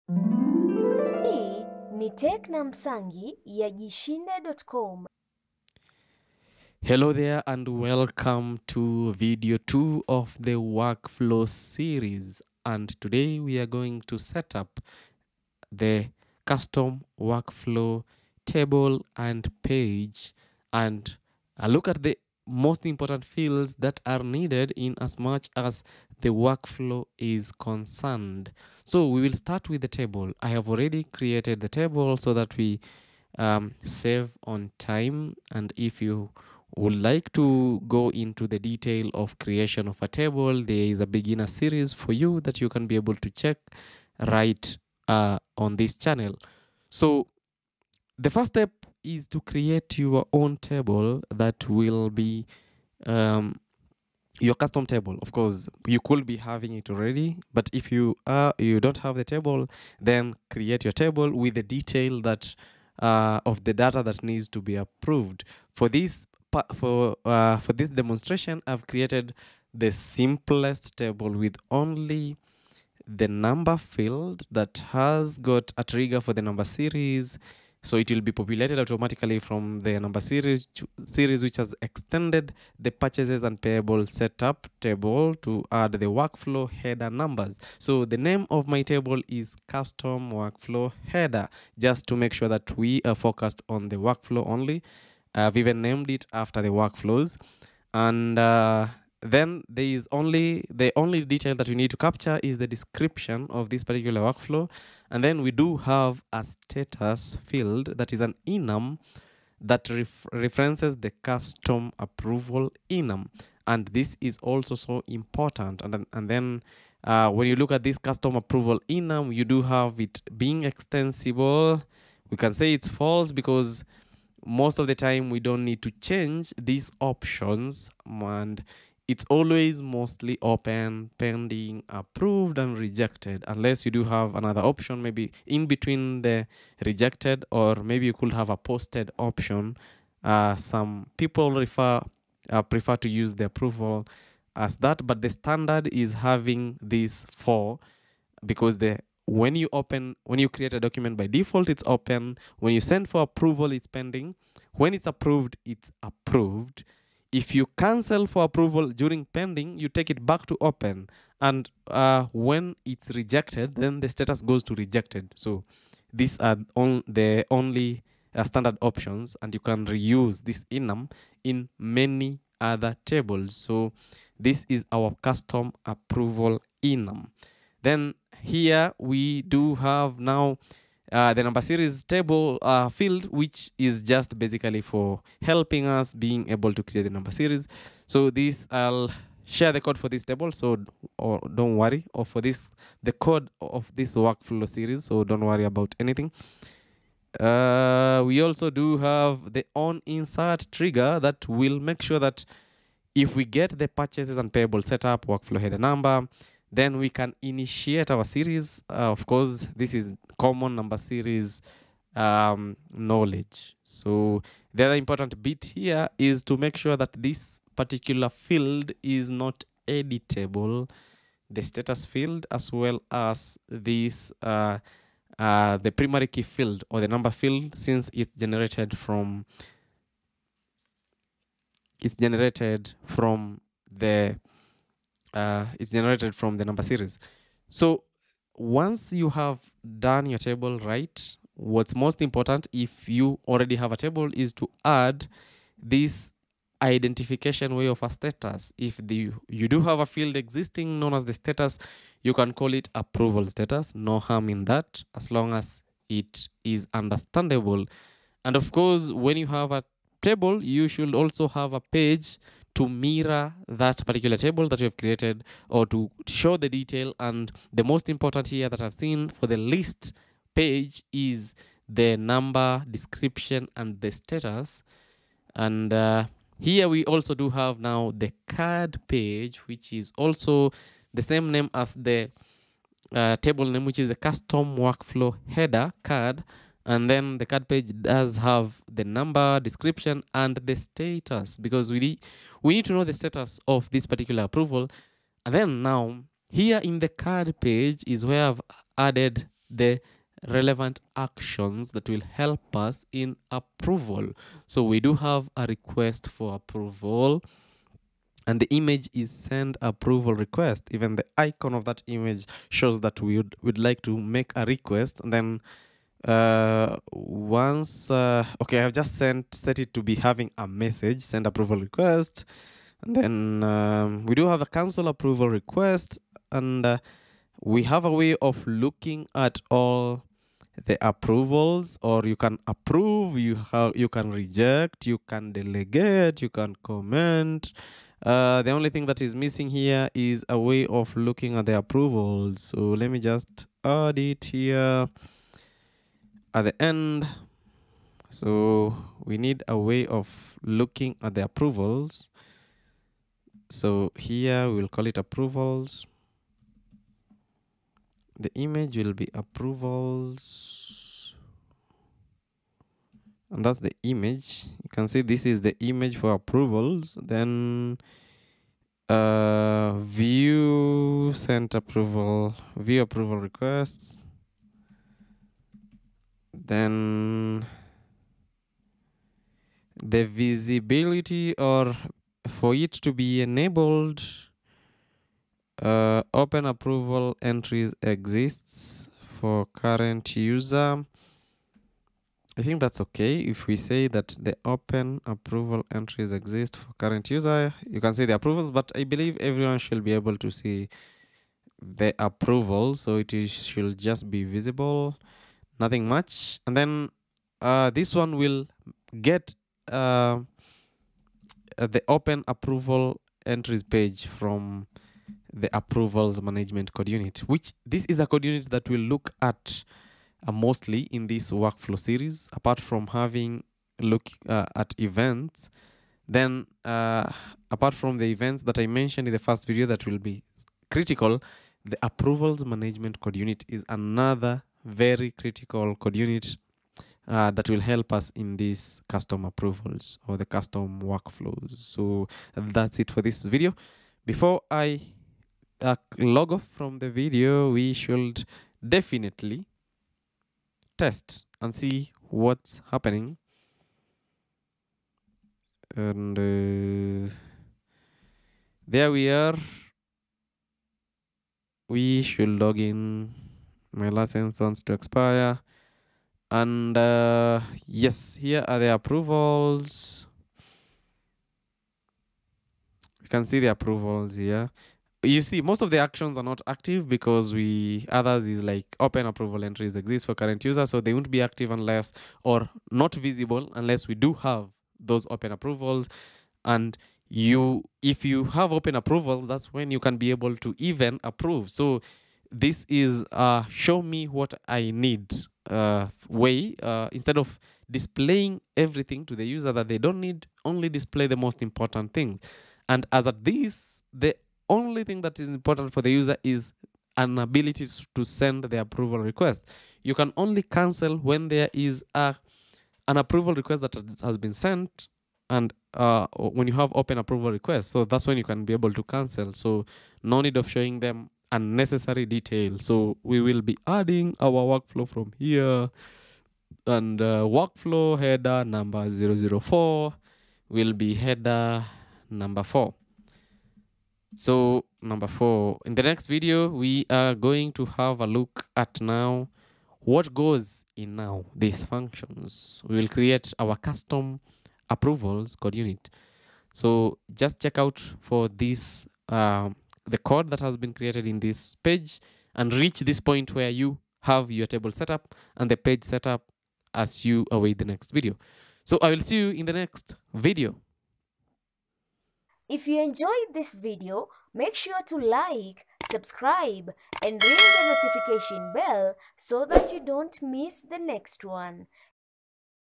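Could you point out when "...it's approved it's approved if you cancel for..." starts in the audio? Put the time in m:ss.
2:34.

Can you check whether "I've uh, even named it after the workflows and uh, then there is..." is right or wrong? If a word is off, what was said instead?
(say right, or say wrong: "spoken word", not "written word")
right.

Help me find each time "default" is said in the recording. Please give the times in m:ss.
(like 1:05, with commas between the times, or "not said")
2:31.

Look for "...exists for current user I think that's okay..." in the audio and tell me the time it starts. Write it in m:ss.
6:28.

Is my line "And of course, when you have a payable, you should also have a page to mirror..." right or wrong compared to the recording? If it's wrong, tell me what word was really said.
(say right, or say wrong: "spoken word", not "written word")
wrong: "table", not "payable".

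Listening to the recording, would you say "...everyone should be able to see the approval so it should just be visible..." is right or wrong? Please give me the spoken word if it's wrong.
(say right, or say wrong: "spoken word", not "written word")
right.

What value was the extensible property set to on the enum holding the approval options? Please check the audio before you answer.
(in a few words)
False.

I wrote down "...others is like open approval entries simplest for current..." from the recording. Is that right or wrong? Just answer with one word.
wrong.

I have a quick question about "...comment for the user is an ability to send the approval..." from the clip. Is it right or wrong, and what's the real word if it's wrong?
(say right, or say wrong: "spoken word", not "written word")
wrong: "important", not "comment".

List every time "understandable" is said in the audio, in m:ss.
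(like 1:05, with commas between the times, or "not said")
4:16.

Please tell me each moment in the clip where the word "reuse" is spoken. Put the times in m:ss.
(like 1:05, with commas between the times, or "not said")
2:49.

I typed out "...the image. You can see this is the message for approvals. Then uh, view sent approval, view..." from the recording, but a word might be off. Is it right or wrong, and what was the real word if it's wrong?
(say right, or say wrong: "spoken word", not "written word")
wrong: "image", not "message".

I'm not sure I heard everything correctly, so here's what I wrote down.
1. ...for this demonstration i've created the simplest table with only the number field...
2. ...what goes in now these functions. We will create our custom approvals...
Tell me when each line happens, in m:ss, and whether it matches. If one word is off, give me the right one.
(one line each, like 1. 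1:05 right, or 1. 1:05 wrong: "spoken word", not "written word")
1. 1:07 right
2. 8:59 right.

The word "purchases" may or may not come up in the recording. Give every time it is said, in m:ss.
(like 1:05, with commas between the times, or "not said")
1:22, 3:23.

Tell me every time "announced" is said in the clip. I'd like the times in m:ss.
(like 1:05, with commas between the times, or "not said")
not said.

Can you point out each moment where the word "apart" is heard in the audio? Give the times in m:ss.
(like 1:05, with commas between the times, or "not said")
7:02, 7:07.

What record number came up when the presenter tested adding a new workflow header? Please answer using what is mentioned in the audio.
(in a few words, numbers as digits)
004.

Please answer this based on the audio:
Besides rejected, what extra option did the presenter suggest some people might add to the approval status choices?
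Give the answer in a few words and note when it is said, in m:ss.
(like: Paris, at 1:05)
Posted, at 2:18.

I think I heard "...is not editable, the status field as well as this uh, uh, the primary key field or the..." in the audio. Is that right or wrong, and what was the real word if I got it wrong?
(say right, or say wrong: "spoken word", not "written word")
right.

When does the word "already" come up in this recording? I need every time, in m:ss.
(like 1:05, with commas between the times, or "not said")
0:30, 0:56, 4:03.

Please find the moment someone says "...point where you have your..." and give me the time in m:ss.
9:13.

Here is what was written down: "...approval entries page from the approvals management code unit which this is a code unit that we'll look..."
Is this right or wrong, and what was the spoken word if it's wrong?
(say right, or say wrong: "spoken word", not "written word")
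right.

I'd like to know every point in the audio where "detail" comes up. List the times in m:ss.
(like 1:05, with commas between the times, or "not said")
0:38, 1:01, 1:41, 4:26, 8:42.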